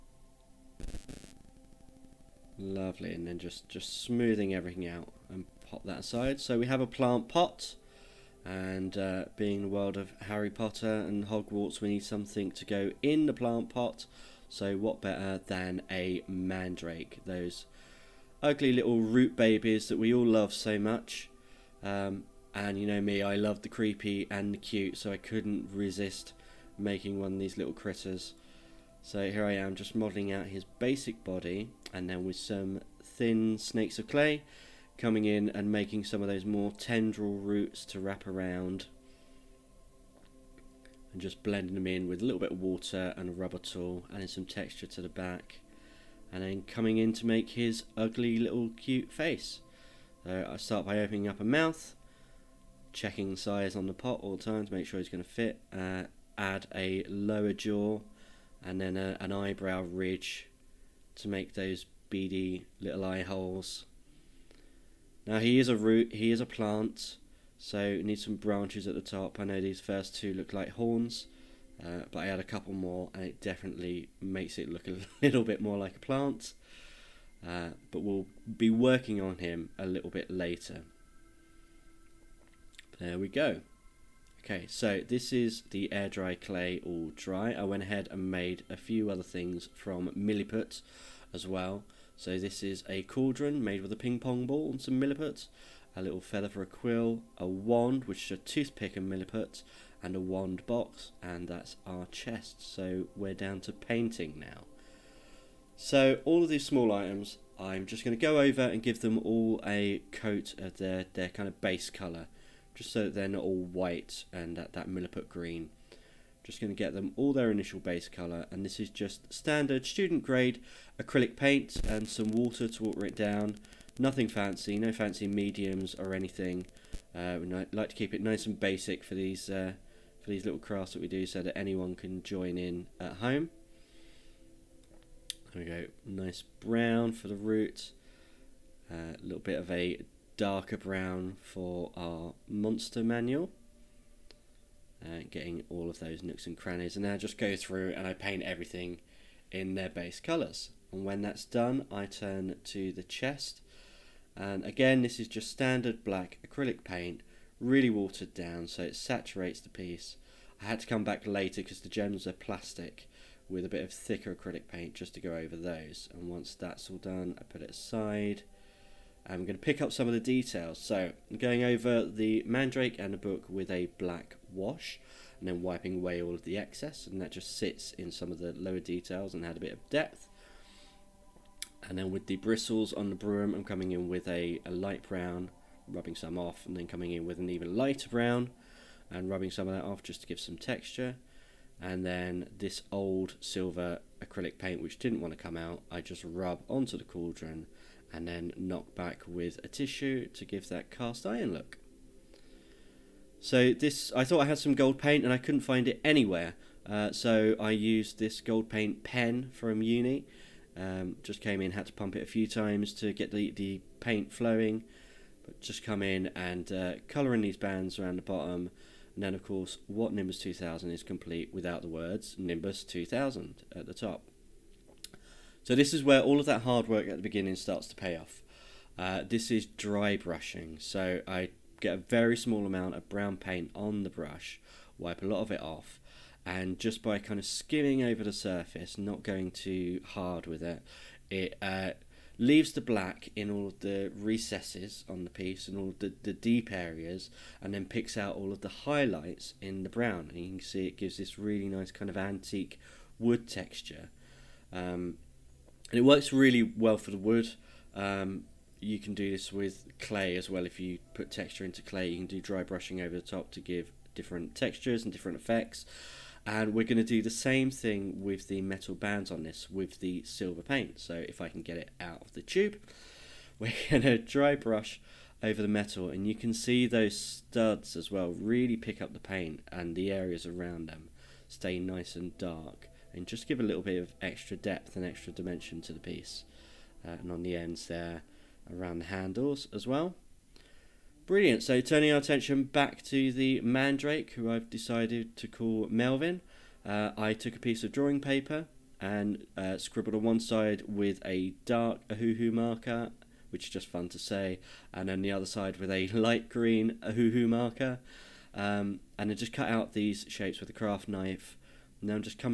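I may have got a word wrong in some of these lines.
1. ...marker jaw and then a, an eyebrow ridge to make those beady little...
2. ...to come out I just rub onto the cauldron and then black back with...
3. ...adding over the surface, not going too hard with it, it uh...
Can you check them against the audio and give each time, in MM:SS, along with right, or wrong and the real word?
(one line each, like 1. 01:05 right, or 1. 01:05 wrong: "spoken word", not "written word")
1. 00:57 wrong: "lower", not "marker"
2. 03:15 wrong: "knock", not "black"
3. 03:57 wrong: "skimming", not "adding".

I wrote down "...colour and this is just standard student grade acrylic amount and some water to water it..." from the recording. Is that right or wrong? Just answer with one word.
wrong.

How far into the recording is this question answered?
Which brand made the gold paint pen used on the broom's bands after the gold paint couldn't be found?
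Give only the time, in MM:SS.
03:29.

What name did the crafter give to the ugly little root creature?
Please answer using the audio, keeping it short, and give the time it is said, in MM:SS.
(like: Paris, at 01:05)
Melvin, at 04:55.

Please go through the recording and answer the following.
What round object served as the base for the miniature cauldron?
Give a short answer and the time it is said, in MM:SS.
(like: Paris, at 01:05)
Ping pong ball, at 01:33.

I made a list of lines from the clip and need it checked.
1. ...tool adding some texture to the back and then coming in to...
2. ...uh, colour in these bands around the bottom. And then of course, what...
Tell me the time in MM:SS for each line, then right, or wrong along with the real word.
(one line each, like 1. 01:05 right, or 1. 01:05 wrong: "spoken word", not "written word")
1. 00:43 right
2. 03:36 right.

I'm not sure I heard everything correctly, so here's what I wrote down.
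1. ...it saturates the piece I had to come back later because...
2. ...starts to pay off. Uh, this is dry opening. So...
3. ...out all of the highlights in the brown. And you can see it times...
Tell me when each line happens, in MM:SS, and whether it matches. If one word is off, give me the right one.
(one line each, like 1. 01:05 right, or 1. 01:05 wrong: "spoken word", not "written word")
1. 02:38 right
2. 03:47 wrong: "brushing", not "opening"
3. 04:08 wrong: "gives", not "times".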